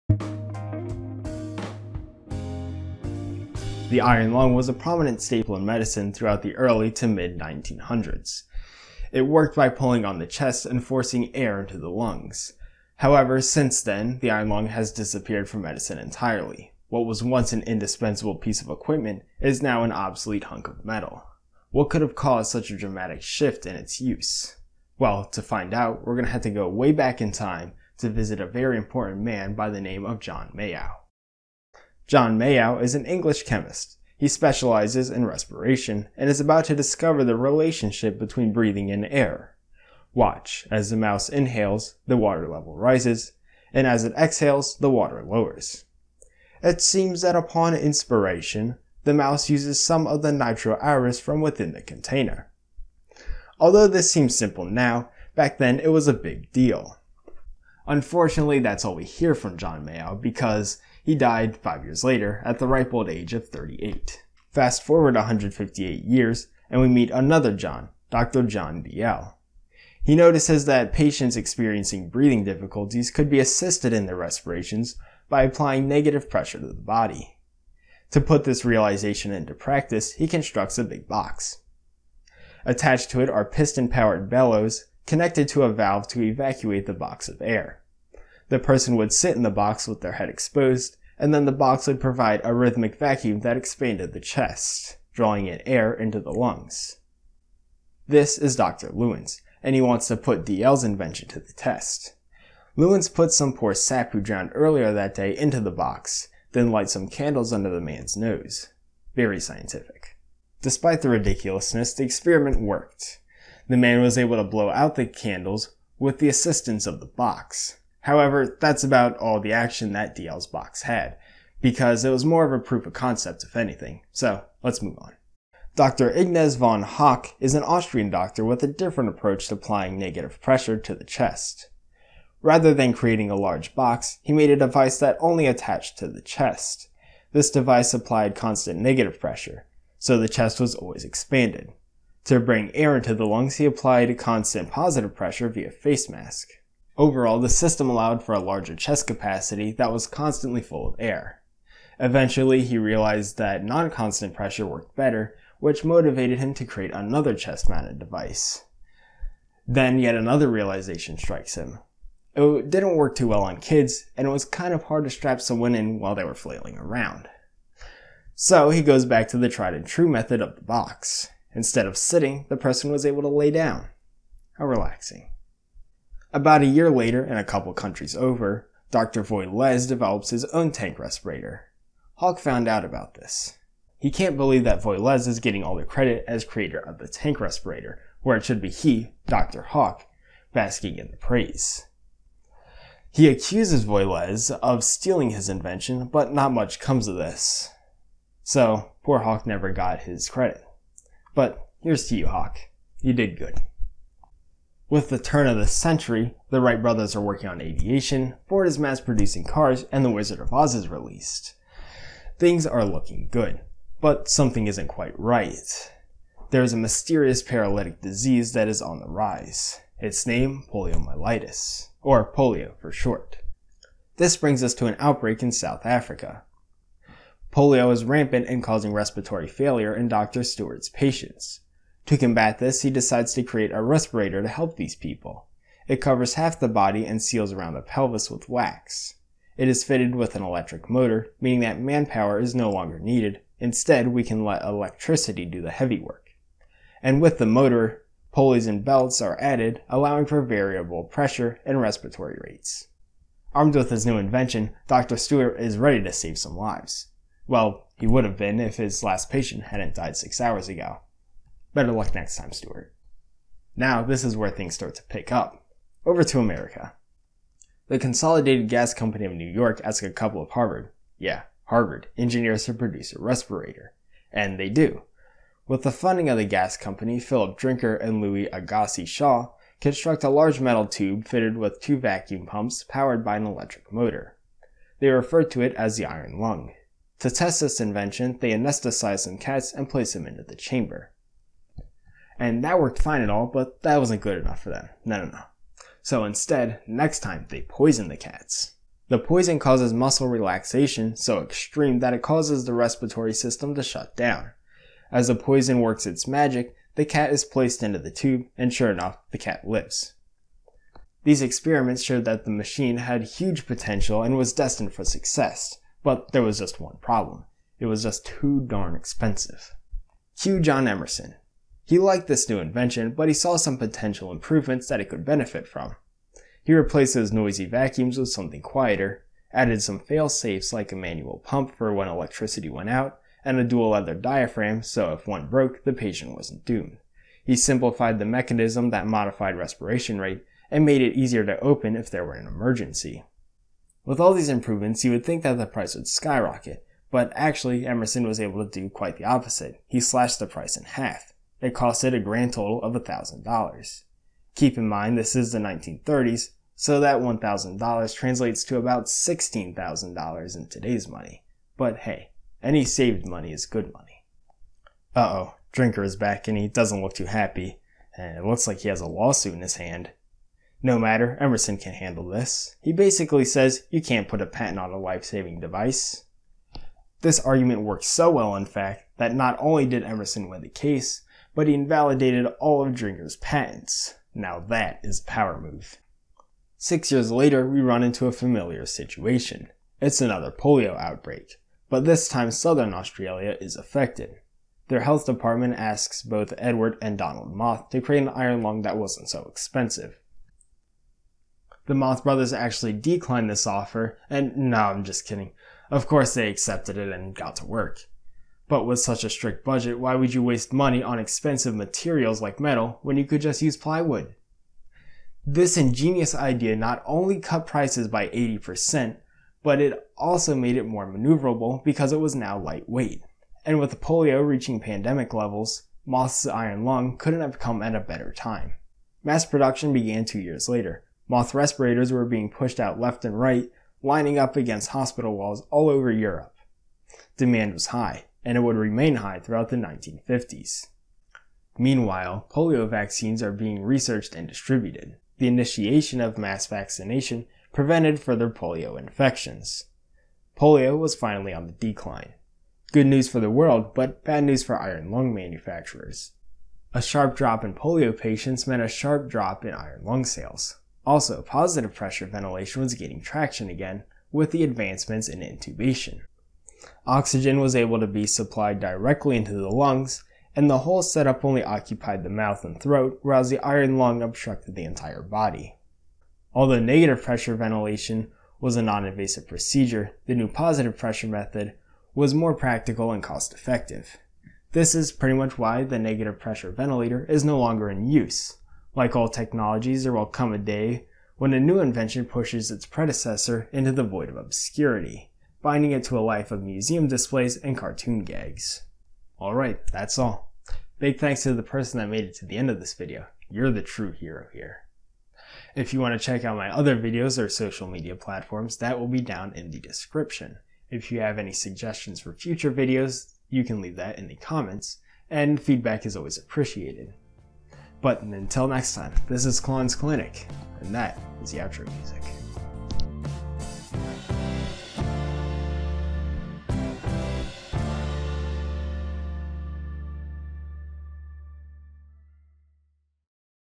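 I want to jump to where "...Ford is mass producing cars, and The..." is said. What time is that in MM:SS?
03:28.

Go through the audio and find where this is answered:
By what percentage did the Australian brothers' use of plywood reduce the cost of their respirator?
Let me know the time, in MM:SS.
06:58.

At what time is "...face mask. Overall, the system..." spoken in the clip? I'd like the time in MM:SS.
02:25.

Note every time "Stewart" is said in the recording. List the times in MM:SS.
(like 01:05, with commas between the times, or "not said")
03:50, 04:15.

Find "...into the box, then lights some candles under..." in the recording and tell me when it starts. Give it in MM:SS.
01:45.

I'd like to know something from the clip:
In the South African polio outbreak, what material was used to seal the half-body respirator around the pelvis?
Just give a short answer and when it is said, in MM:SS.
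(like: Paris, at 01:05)
wax, at 03:58.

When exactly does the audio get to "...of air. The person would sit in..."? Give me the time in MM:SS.
01:27.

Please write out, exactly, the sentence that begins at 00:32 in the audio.
John Mayow is an English chemist.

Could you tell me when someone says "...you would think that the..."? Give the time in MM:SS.
05:45.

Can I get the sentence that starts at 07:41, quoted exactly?
Also, positive pressure ventilation was gaining traction again with the advancements in intubation.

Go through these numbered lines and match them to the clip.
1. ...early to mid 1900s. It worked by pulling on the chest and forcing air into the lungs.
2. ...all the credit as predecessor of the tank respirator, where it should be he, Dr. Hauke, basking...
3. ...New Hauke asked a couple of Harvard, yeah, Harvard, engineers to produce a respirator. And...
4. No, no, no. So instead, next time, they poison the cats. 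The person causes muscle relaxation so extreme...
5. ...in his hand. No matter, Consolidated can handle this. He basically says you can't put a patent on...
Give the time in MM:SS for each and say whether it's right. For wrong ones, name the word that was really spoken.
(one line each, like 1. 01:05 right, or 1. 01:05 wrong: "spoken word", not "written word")
1. 00:06 right
2. 03:05 wrong: "creator", not "predecessor"
3. 04:29 wrong: "York", not "Hauke"
4. 04:55 wrong: "poison", not "person"
5. 06:09 wrong: "Emerson", not "Consolidated".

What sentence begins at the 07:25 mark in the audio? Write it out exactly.
The initiation of mass vaccination prevented further polio infections.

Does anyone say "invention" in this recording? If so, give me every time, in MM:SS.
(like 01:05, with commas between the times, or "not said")
01:40, 03:15, 04:14, 04:47, 05:22, 08:11.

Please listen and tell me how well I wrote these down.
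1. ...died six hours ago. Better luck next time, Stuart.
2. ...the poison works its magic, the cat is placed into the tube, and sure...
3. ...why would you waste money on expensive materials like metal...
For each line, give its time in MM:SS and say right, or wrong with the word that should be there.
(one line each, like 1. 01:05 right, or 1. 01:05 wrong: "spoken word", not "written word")
1. 04:19 right
2. 05:05 right
3. 06:49 right.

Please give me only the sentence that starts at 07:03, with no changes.
And with polio reaching pandemic levels, Both's iron lung couldn't have come at a better time.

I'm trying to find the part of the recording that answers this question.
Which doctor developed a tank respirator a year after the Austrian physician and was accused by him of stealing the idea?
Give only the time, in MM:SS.
02:58.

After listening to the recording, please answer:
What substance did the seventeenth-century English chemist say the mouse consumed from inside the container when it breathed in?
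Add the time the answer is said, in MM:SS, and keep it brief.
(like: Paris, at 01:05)
nitro-aereus, at 00:50.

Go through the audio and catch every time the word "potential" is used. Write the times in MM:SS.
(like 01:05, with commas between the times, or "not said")
05:13, 05:23.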